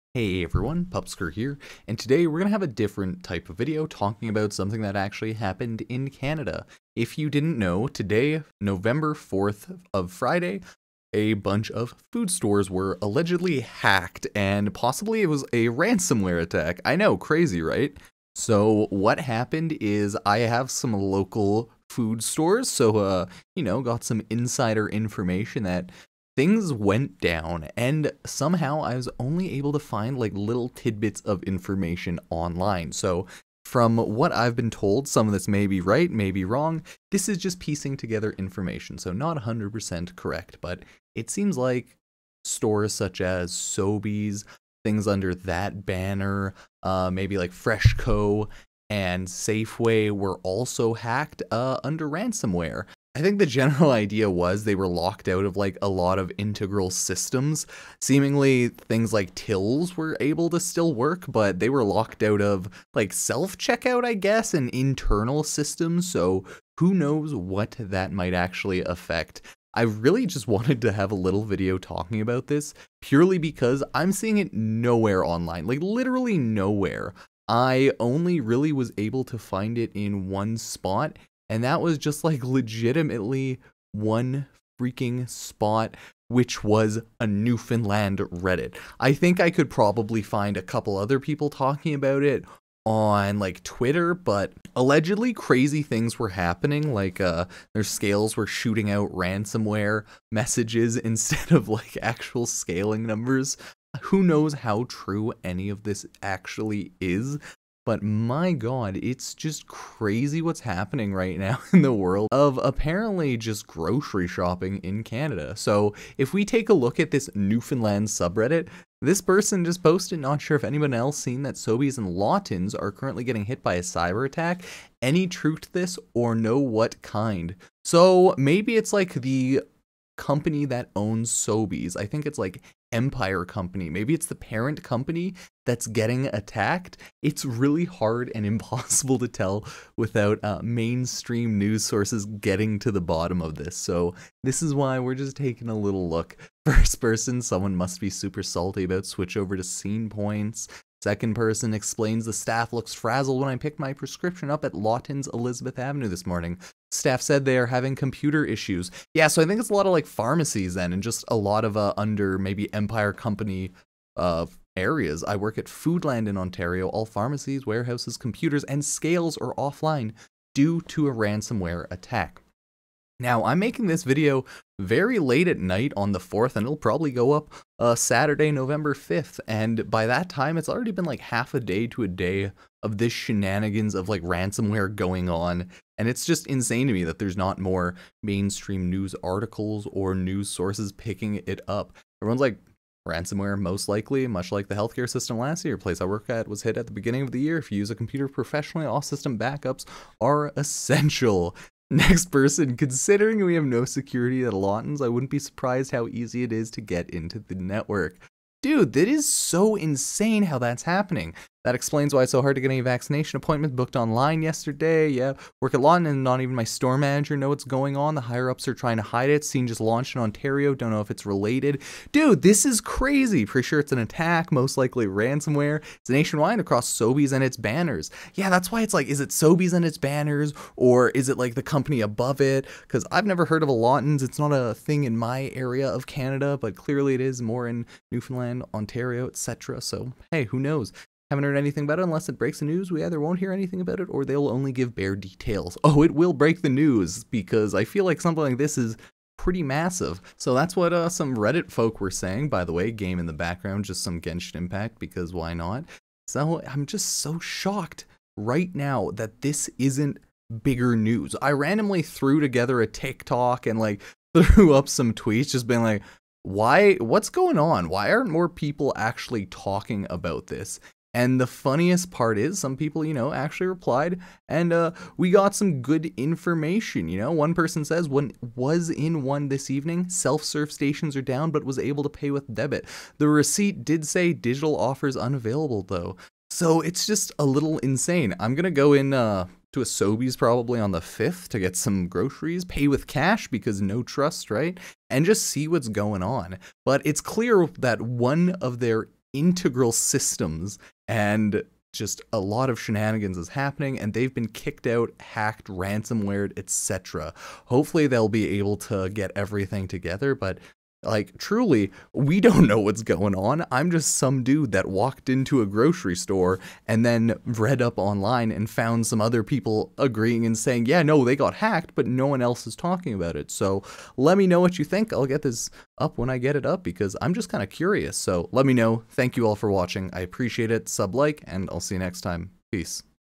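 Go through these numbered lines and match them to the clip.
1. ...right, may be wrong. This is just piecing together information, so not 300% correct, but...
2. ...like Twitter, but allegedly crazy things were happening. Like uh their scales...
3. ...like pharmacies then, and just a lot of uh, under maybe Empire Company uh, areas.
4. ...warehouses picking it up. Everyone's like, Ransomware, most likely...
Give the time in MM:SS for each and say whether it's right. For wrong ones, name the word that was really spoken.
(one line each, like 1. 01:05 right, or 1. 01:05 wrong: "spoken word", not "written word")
1. 00:35 wrong: "100", not "300"
2. 01:33 right
3. 02:39 right
4. 03:10 wrong: "sources", not "warehouses".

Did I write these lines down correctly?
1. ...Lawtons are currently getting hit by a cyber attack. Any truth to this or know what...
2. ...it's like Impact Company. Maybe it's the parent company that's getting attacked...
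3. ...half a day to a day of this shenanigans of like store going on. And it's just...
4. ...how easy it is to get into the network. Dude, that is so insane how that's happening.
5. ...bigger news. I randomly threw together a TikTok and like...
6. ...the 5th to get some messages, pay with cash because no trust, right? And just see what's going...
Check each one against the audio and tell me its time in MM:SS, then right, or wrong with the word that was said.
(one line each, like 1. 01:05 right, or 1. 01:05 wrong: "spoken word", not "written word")
1. 02:02 right
2. 02:12 wrong: "Empire", not "Impact"
3. 03:01 wrong: "ransomware", not "store"
4. 03:25 right
5. 04:20 right
6. 04:50 wrong: "groceries", not "messages".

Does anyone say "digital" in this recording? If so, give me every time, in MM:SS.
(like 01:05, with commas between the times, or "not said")
04:44.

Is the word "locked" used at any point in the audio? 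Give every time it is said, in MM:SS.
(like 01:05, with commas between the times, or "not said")
00:54, 01:01.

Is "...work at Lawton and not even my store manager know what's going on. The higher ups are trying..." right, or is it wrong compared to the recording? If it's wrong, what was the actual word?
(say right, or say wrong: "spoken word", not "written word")
right.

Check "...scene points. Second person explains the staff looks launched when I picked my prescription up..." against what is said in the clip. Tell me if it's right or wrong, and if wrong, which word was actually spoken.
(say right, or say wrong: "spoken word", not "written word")
wrong: "frazzled", not "launched".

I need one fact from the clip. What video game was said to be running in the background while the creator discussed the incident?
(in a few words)
Genshin Impact.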